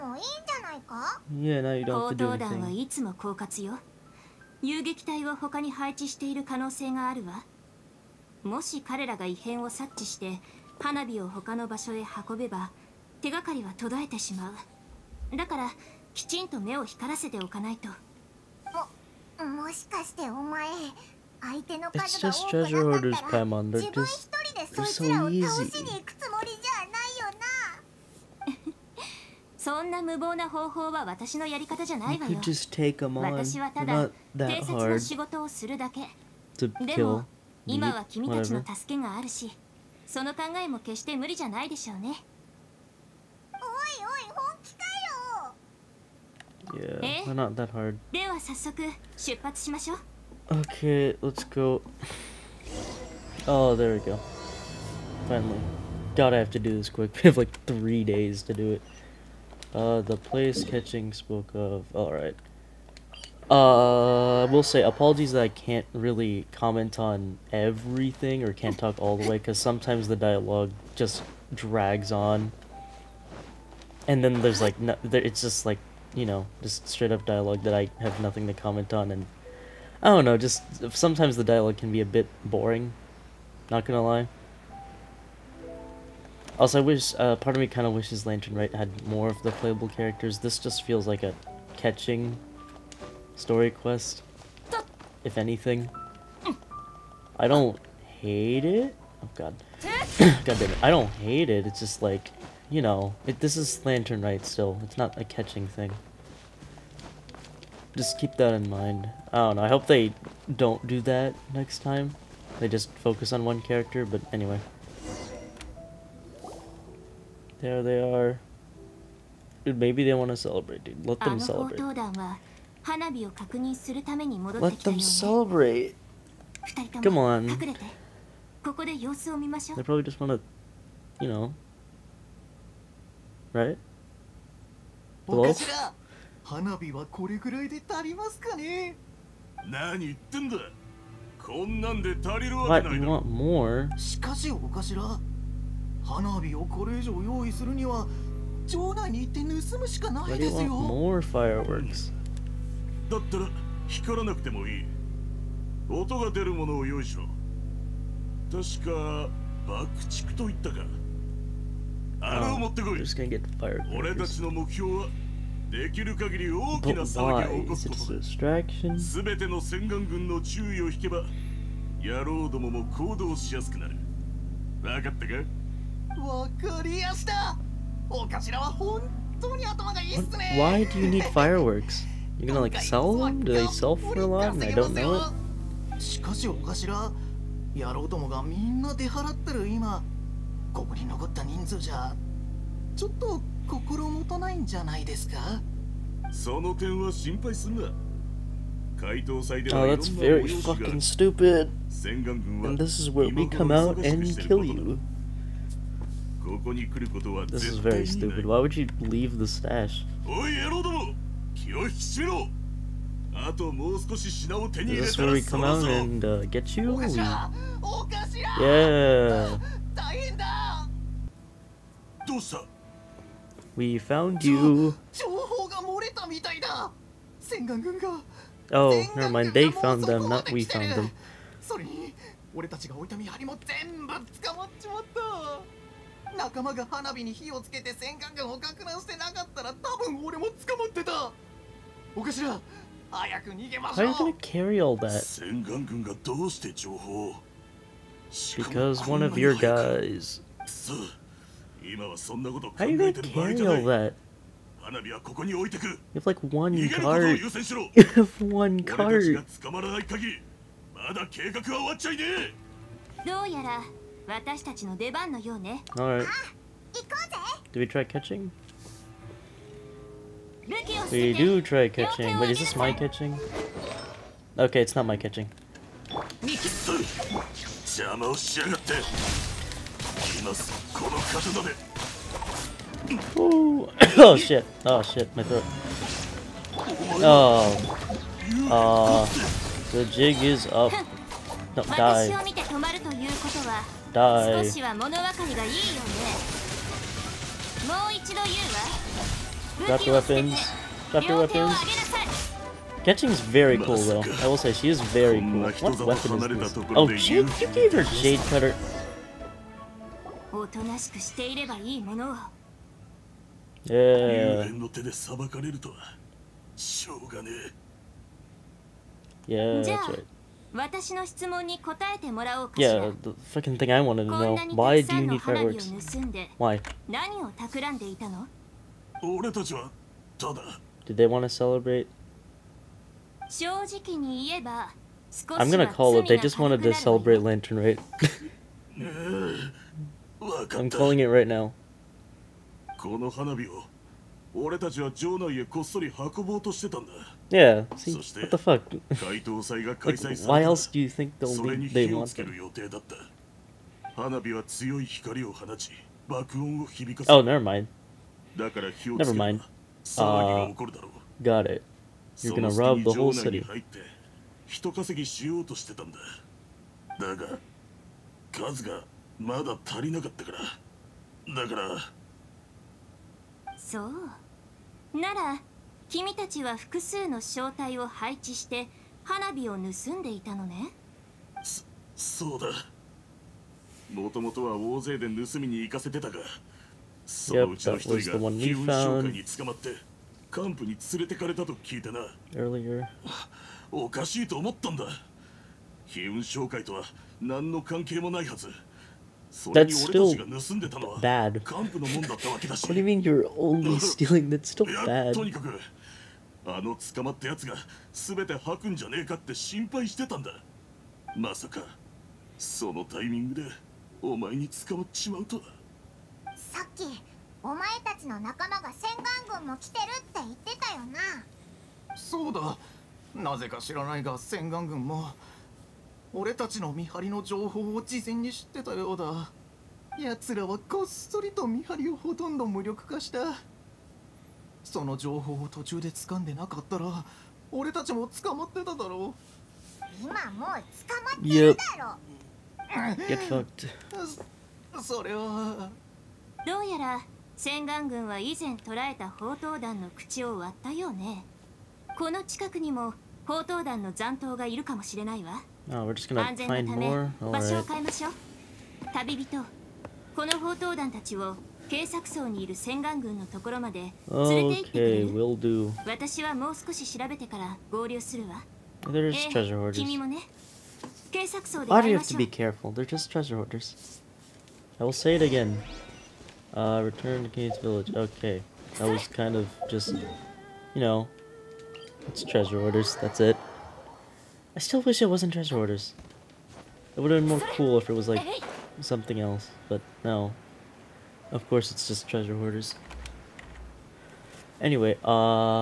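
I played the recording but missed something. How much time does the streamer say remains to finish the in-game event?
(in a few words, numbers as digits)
3 days.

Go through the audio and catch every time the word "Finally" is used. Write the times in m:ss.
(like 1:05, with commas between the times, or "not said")
0:55.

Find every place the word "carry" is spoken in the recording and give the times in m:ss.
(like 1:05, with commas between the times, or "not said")
4:04, 4:12.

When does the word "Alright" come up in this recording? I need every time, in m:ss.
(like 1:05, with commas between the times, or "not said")
1:01, 7:37.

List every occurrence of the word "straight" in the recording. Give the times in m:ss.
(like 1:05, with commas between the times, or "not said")
1:16.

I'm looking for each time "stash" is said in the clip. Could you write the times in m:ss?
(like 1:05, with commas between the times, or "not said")
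3:29.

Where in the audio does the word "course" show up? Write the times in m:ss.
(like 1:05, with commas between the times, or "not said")
8:11.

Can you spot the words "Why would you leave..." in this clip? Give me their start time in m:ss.
3:28.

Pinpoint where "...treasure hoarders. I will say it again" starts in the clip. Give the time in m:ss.
7:53.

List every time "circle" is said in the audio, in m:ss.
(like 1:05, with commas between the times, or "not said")
not said.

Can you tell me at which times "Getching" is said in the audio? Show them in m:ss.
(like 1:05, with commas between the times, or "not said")
5:03.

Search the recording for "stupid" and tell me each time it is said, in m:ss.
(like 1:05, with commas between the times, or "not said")
3:21, 3:28.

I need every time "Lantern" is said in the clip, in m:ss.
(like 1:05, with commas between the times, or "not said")
1:28, 1:43, 5:37.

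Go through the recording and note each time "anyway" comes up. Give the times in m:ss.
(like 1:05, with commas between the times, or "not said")
1:54, 8:14.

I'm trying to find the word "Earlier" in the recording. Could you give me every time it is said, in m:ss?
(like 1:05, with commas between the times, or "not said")
6:32.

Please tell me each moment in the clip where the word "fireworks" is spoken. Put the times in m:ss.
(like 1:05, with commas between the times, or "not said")
2:31, 3:01, 5:25.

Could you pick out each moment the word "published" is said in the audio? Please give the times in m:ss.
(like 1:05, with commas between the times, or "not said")
not said.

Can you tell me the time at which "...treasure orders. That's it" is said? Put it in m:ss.
8:02.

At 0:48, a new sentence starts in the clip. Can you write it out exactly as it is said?
で は 早 速 出 発 し ま し ょ う。 Okay, let's go.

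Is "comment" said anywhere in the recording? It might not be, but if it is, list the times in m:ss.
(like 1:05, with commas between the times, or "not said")
1:06, 1:18.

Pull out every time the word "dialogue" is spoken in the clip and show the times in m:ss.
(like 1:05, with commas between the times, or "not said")
1:10, 1:17, 1:21.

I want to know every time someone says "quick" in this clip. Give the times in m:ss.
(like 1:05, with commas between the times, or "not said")
0:56.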